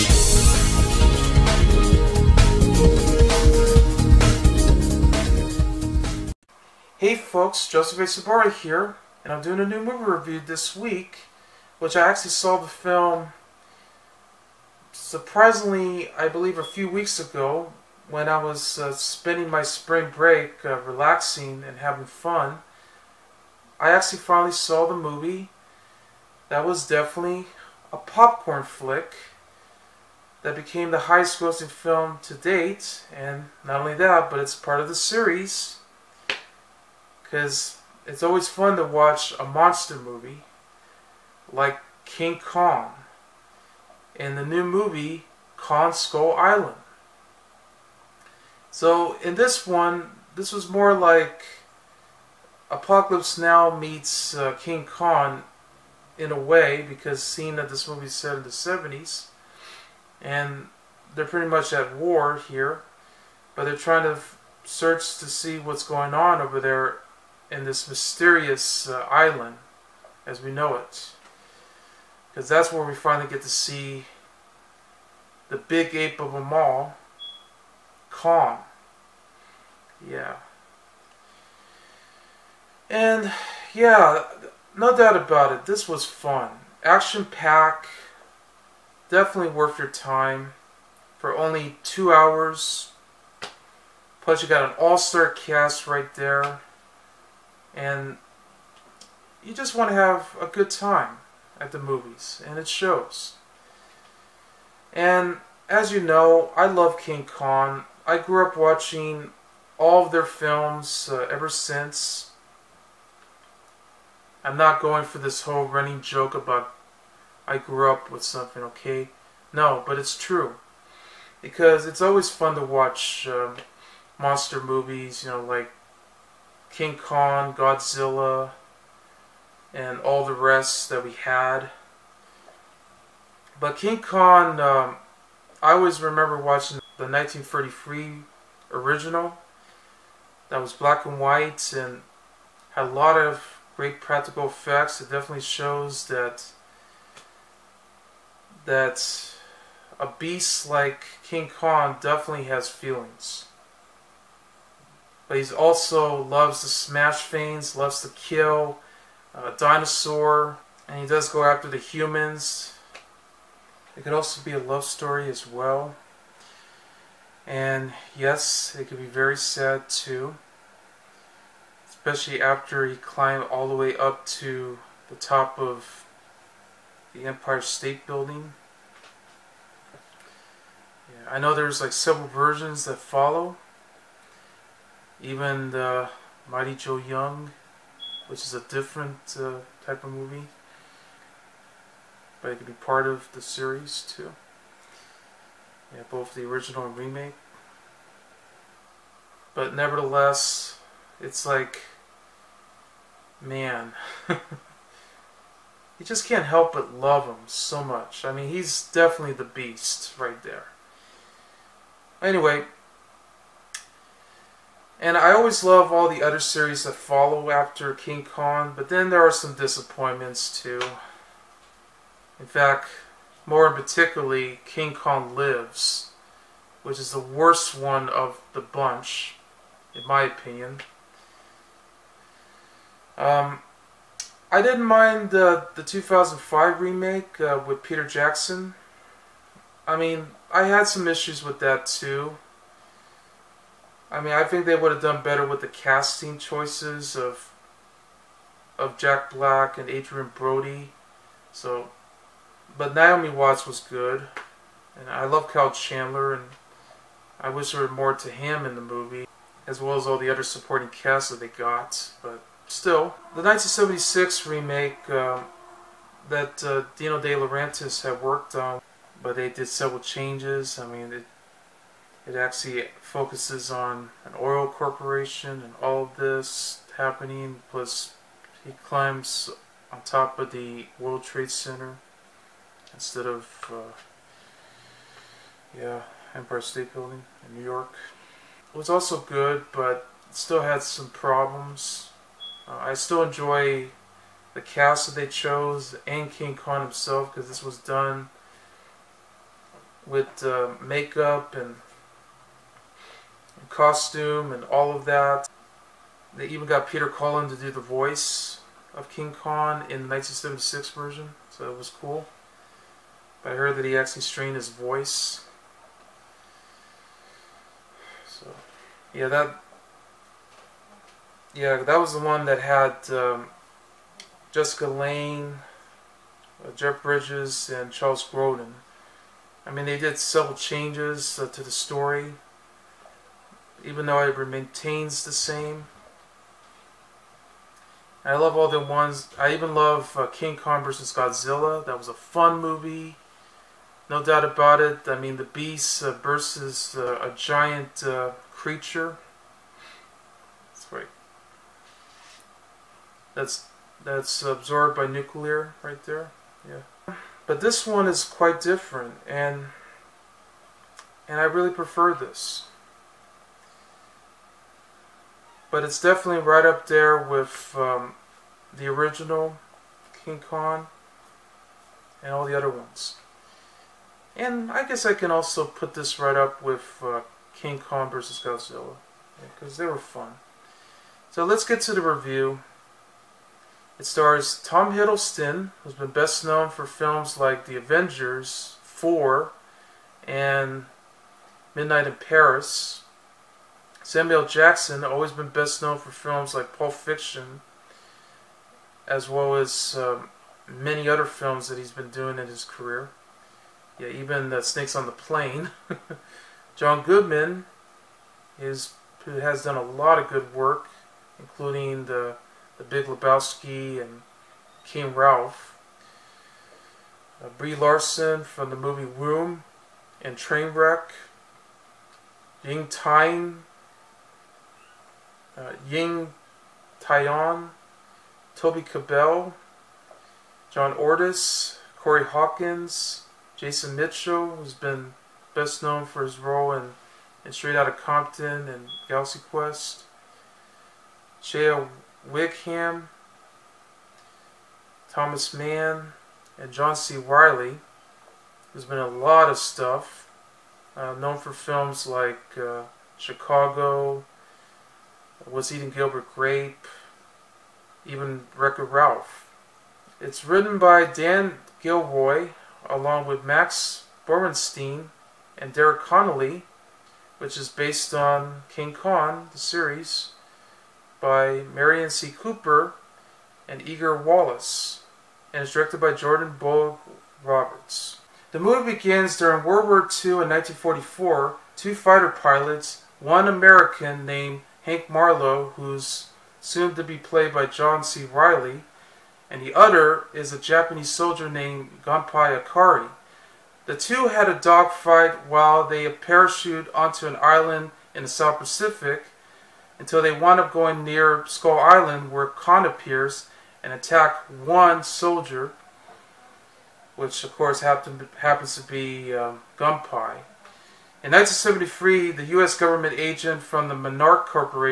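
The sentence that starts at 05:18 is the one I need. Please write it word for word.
So, yeah, that yeah, that was the one that had um, Jessica Lange, uh, Jeff Bridges, and Charles Grodin.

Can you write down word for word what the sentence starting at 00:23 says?
I actually finally saw the movie.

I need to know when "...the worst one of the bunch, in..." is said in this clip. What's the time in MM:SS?
03:47.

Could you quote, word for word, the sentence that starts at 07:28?
There's been a lot of stuff, uh, known for films like uh, Chicago, was Eating Gilbert Grape, even Wreck-It Ralph.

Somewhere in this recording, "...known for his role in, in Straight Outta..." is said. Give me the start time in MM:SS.
07:15.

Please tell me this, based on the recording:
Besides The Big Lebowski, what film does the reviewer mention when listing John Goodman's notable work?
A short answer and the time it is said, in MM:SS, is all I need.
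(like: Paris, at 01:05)
King Ralph, at 06:54.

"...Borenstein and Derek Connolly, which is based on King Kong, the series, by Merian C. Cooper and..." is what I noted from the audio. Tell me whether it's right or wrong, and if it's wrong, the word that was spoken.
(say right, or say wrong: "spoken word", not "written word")
right.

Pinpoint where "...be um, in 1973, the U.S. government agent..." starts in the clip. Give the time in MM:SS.
08:28.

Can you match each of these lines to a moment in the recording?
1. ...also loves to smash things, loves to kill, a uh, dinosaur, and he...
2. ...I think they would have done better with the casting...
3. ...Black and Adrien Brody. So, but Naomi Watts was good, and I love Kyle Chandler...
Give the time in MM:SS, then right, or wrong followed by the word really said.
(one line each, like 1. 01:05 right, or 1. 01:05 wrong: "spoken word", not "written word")
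1. 02:35 right
2. 04:04 right
3. 04:09 right.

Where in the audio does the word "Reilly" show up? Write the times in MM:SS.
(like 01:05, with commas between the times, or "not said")
07:27, 08:08.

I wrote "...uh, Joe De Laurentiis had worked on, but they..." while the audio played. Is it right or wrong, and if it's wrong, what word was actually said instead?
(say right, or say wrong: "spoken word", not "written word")
wrong: "Dino", not "Joe".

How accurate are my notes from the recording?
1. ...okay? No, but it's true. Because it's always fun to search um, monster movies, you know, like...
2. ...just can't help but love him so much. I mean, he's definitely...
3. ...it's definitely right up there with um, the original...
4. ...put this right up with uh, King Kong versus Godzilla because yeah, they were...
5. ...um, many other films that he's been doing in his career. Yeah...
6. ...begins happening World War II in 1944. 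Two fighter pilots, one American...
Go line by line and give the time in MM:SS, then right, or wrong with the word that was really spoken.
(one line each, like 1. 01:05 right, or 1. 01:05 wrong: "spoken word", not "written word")
1. 01:58 wrong: "watch", not "search"
2. 03:26 right
3. 06:05 right
4. 06:15 right
5. 06:39 right
6. 07:58 wrong: "during", not "happening".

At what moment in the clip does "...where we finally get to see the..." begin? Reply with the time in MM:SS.
01:12.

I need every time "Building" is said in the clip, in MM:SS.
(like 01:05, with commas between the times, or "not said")
02:58, 04:46.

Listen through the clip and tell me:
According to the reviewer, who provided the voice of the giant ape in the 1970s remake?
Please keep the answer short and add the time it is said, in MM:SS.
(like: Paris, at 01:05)
Peter Cullen, at 05:06.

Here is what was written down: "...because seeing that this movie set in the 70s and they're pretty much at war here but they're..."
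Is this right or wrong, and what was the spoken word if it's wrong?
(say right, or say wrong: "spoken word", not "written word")
right.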